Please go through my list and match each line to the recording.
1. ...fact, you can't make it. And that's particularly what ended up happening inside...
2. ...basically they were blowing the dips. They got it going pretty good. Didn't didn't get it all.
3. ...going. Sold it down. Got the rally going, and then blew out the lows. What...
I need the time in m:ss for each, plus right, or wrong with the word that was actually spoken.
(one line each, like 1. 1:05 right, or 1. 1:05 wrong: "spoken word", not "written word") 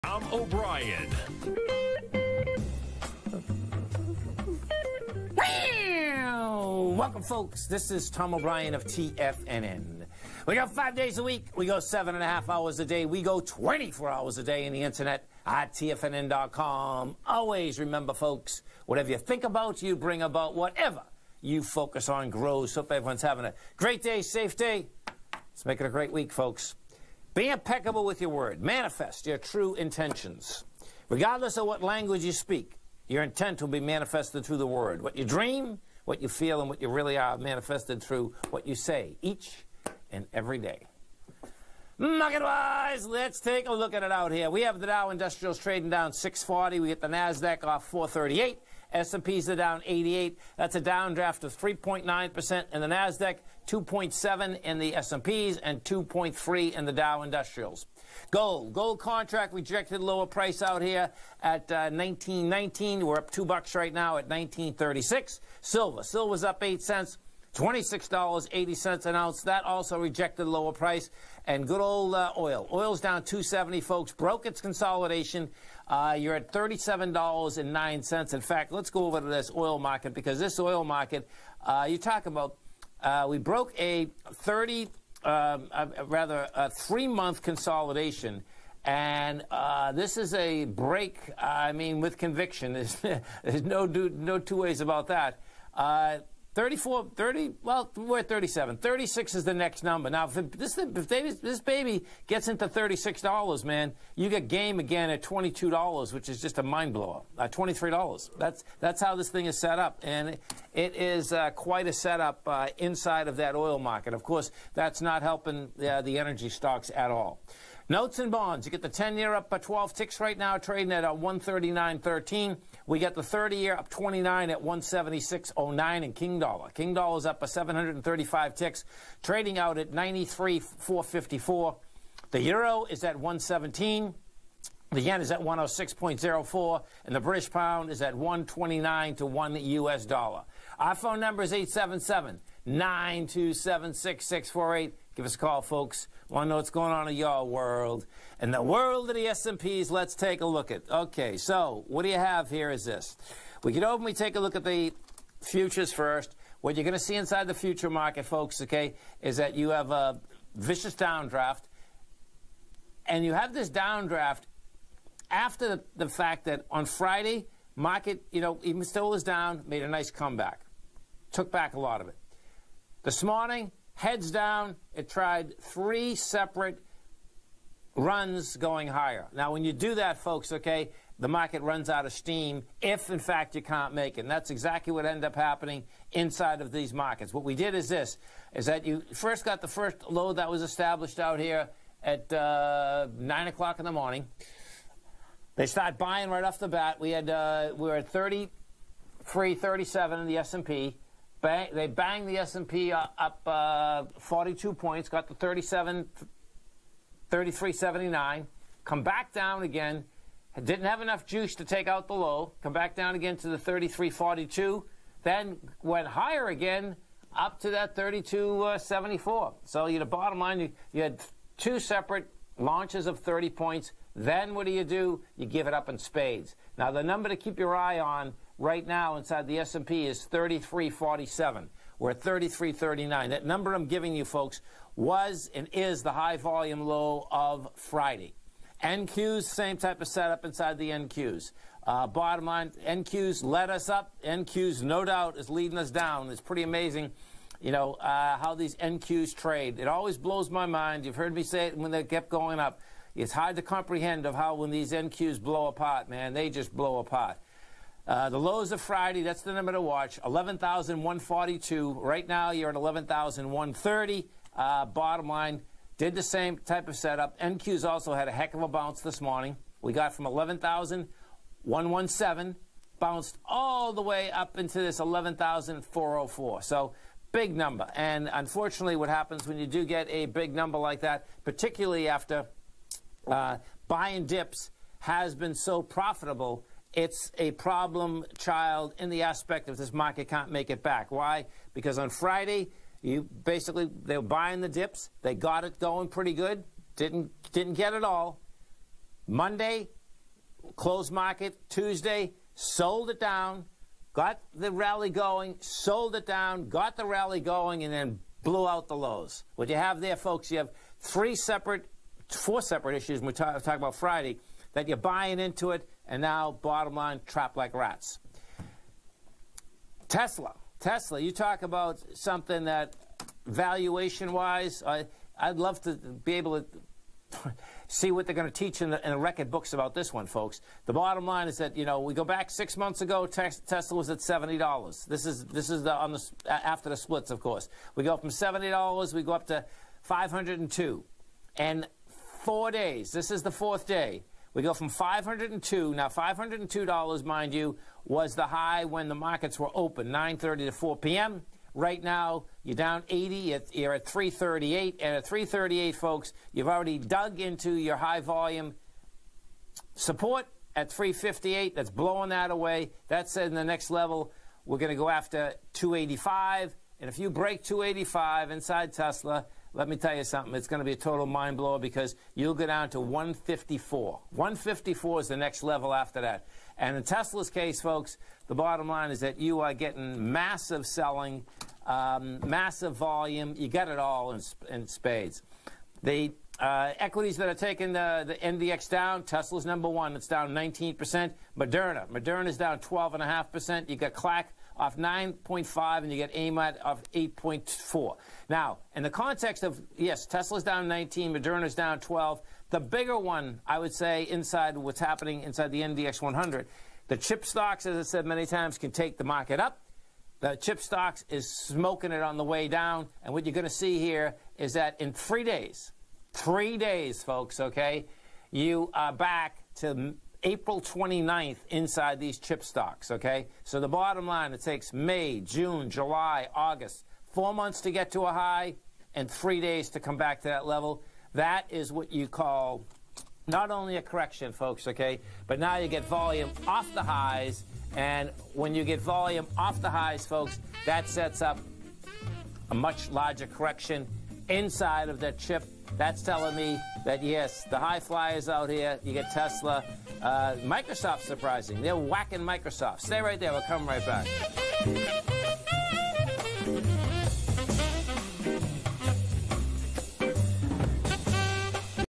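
1. 3:03 wrong: "exactly", not "particularly"
2. 4:53 wrong: "buying", not "blowing"
3. 5:05 right.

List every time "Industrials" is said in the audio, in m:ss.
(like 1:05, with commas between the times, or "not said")
0:45, 0:57.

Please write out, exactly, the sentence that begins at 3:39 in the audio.
Uh, so you, the bottom line, you, you had two separate launches of 30 points, then what do you do?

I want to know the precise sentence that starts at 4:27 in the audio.
NQs also had a heck of a bounce this morning.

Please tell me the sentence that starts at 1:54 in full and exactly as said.
Of course, that's not helping uh, the energy stocks at all.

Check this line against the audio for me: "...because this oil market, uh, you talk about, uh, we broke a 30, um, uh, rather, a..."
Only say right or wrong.
right.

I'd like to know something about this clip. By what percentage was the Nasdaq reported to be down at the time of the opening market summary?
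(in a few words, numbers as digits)
3.9%.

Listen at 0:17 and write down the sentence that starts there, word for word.
Always remember, folks, whatever you think about, you bring about.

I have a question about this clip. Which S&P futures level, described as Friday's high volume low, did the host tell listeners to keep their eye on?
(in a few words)
3347.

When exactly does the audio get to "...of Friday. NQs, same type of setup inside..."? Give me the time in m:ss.
3:57.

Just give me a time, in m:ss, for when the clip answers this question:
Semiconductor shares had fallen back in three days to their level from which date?
7:00.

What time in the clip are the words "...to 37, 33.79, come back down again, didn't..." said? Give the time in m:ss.
3:25.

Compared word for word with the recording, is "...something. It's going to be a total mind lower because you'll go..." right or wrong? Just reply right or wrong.
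wrong.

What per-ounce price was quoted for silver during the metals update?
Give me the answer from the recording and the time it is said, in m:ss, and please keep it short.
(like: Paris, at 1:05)
$26.80, at 1:07.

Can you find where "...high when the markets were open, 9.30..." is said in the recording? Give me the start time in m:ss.
5:48.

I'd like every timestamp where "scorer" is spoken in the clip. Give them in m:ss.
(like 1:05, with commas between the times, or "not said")
not said.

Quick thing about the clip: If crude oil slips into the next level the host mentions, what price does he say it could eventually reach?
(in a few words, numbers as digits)
$22.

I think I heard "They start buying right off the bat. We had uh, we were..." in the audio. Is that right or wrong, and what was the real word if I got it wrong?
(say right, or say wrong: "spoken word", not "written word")
right.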